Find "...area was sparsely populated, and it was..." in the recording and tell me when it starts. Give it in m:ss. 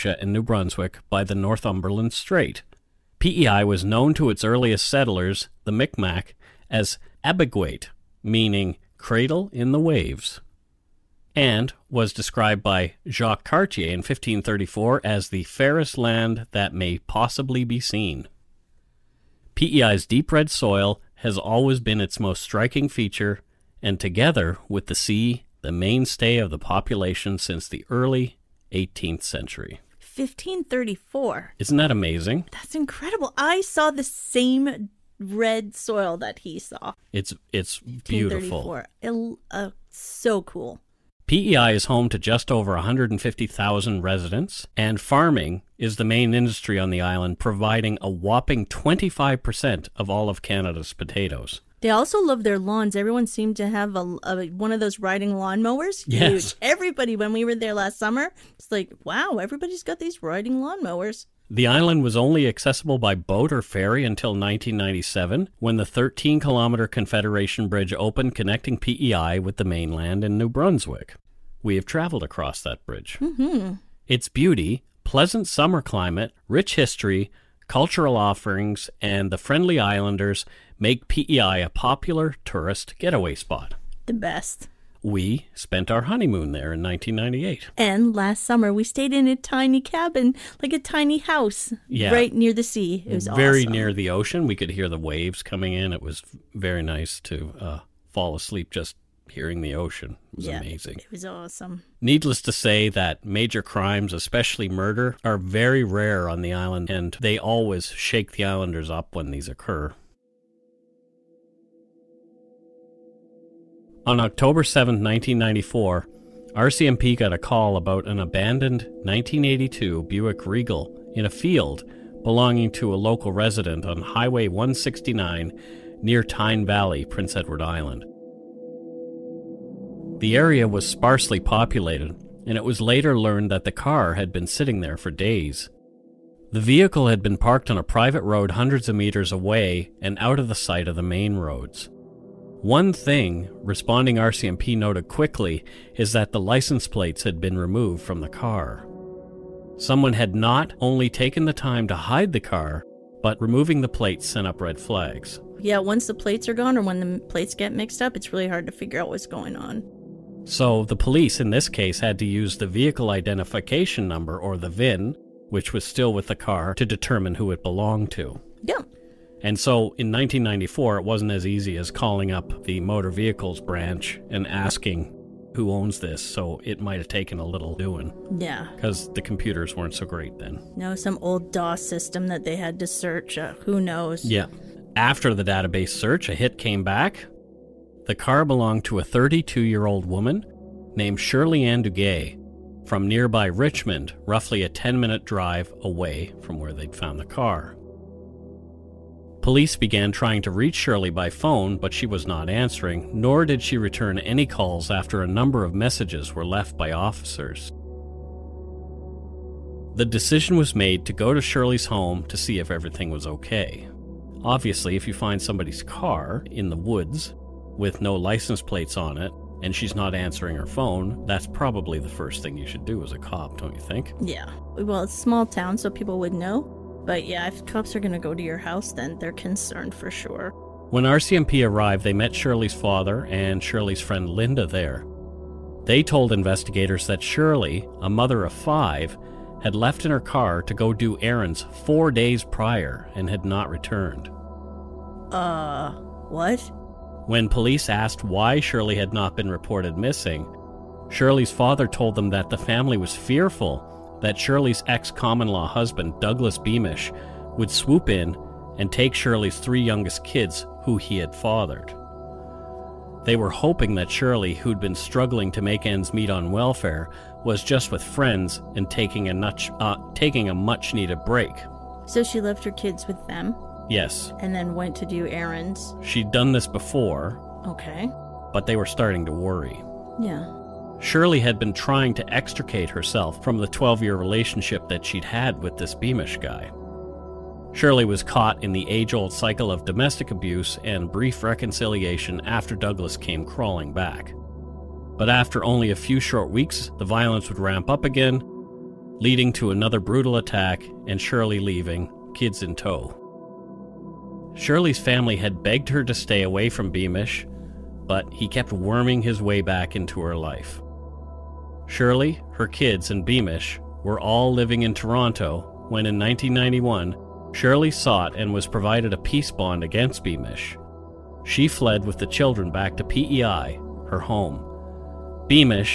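2:10.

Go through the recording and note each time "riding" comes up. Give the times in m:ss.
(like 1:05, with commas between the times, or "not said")
0:54, 1:00.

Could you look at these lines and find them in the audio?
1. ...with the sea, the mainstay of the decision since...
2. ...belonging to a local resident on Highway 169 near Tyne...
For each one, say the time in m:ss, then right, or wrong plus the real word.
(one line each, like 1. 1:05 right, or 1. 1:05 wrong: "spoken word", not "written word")
1. 0:24 wrong: "population", not "decision"
2. 2:02 right.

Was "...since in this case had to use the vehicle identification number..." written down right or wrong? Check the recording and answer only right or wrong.
wrong.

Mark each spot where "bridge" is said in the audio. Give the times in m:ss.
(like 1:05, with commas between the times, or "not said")
1:07, 1:12.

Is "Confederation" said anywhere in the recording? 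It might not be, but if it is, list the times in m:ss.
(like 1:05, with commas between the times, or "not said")
1:06.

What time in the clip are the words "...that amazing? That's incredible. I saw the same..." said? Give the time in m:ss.
0:31.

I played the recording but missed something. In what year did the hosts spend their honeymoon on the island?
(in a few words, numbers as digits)
1998.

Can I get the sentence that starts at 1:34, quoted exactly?
We could hear the waves coming in.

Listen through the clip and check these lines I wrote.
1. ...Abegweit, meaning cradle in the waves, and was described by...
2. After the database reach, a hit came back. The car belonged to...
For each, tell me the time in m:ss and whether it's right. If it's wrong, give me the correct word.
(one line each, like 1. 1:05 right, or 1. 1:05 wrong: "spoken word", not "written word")
1. 0:07 right
2. 3:04 wrong: "search", not "reach".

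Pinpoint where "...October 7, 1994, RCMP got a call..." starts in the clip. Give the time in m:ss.
1:54.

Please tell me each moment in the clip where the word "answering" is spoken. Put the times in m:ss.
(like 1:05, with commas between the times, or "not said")
3:22, 3:40.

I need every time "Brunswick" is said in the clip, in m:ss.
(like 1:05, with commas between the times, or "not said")
0:00, 1:10.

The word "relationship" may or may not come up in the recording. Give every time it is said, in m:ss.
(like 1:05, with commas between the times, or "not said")
4:44.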